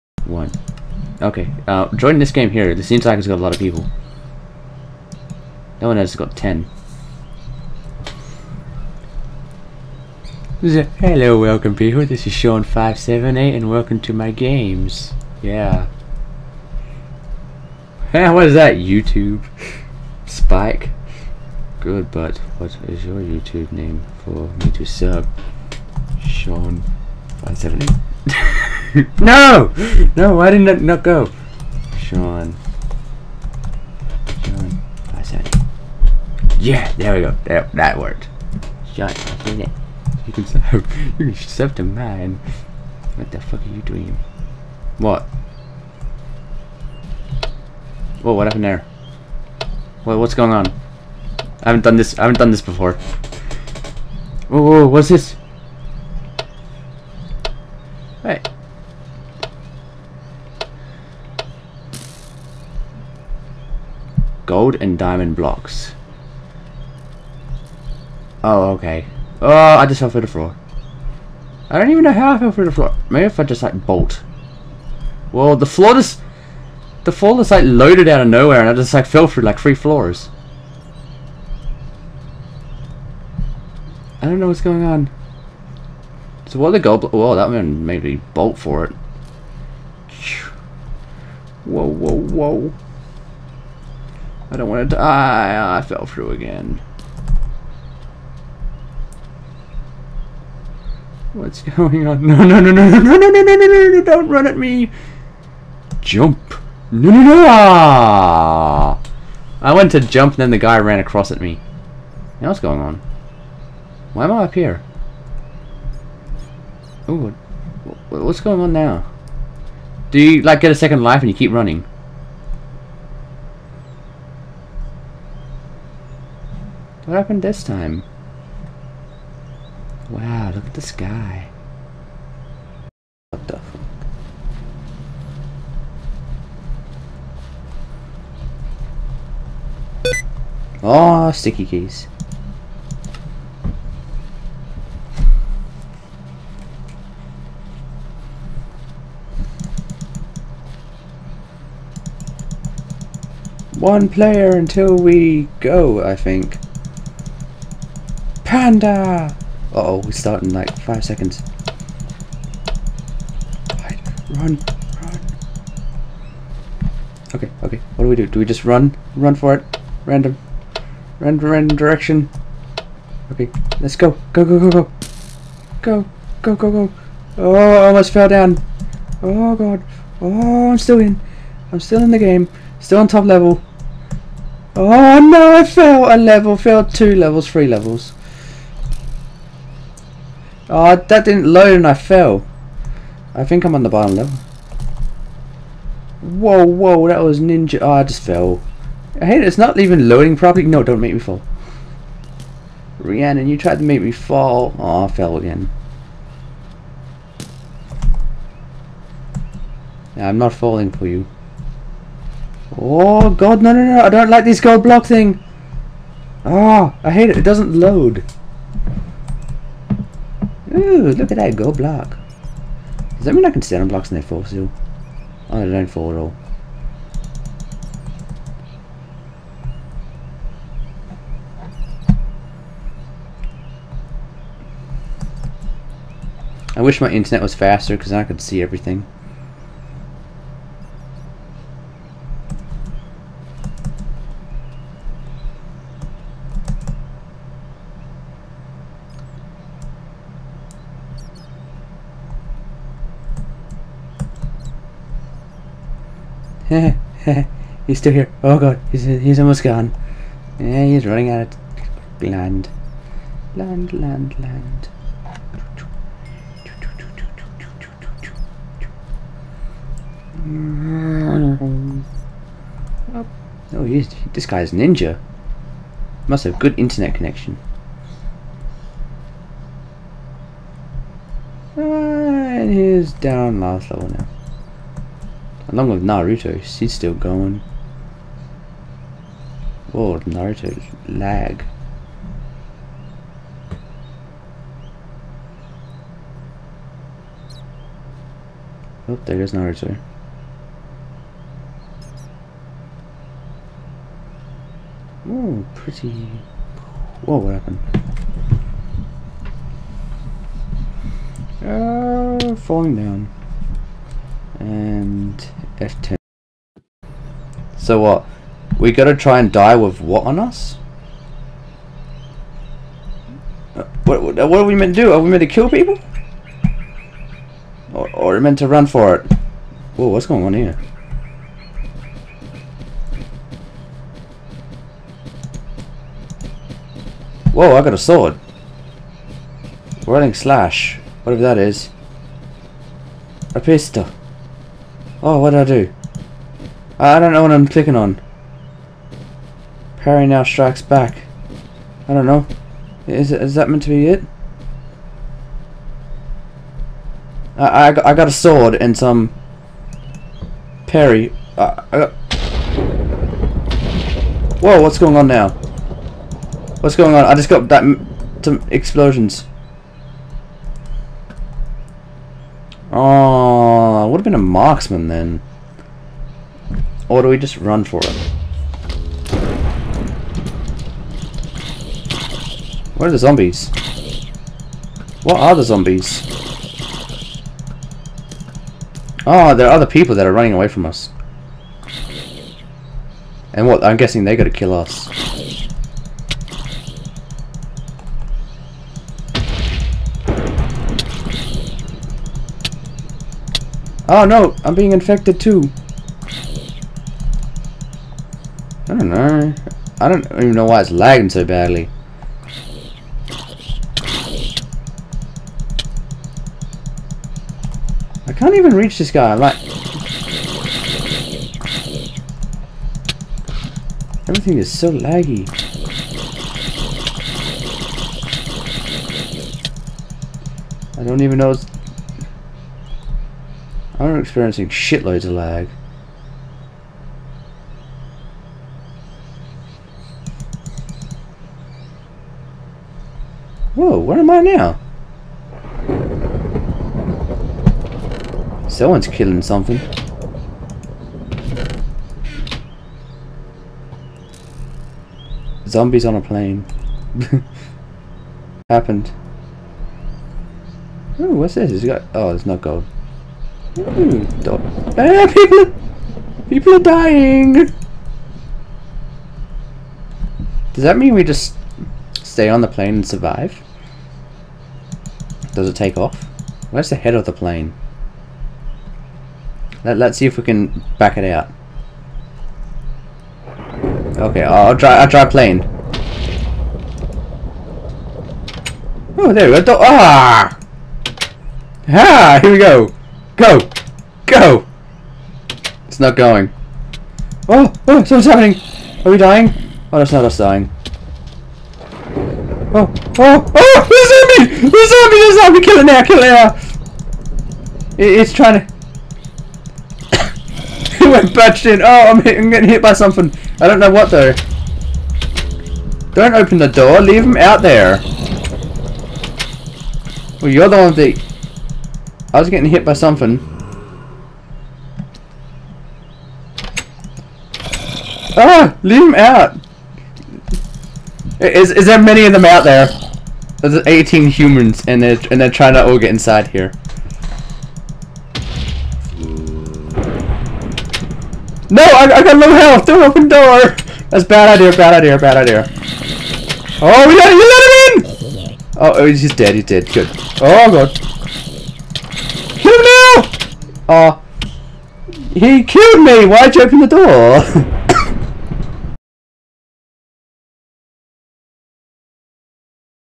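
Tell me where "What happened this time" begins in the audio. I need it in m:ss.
2:07.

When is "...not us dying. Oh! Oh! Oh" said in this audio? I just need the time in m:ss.
8:20.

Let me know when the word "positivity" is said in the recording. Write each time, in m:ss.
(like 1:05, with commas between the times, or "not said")
not said.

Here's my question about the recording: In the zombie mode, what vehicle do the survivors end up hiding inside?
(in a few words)
a plane.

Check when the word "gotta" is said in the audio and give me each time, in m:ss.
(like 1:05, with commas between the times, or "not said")
5:18.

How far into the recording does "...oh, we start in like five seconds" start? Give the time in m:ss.
2:39.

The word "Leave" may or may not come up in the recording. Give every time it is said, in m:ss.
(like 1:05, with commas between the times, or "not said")
8:37, 8:48.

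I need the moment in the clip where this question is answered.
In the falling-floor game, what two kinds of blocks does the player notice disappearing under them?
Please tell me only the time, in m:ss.
1:04.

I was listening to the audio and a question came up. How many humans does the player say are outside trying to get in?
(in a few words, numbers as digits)
18.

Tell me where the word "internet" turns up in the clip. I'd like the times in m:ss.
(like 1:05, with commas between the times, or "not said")
3:57, 4:36.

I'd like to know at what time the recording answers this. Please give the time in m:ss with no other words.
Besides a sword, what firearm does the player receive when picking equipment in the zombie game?
5:43.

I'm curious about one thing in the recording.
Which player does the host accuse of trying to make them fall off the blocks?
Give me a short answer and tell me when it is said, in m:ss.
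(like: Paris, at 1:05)
Rhiannon, at 3:22.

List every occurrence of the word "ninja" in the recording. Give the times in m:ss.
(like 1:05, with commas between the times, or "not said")
3:17, 4:34.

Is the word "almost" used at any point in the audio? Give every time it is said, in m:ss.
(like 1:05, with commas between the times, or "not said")
2:57, 4:19.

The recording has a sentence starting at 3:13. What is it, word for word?
I think I'm on the bottom level.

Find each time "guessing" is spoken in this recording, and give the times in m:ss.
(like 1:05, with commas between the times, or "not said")
6:33.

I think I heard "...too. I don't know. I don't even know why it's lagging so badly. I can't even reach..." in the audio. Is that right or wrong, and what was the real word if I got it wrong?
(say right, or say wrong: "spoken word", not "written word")
right.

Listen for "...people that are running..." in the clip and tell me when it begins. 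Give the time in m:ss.
6:29.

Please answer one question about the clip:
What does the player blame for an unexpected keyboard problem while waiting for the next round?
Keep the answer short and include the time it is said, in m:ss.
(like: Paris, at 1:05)
sticky keys, at 2:21.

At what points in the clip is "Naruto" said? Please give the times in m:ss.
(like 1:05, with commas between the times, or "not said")
4:46, 4:50, 4:59.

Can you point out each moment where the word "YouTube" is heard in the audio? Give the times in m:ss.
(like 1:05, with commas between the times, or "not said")
0:18, 0:23.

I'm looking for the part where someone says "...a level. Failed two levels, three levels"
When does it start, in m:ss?
3:06.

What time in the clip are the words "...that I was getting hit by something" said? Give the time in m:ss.
8:40.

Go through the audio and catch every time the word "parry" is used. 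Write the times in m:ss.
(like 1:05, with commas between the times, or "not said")
5:49, 6:00.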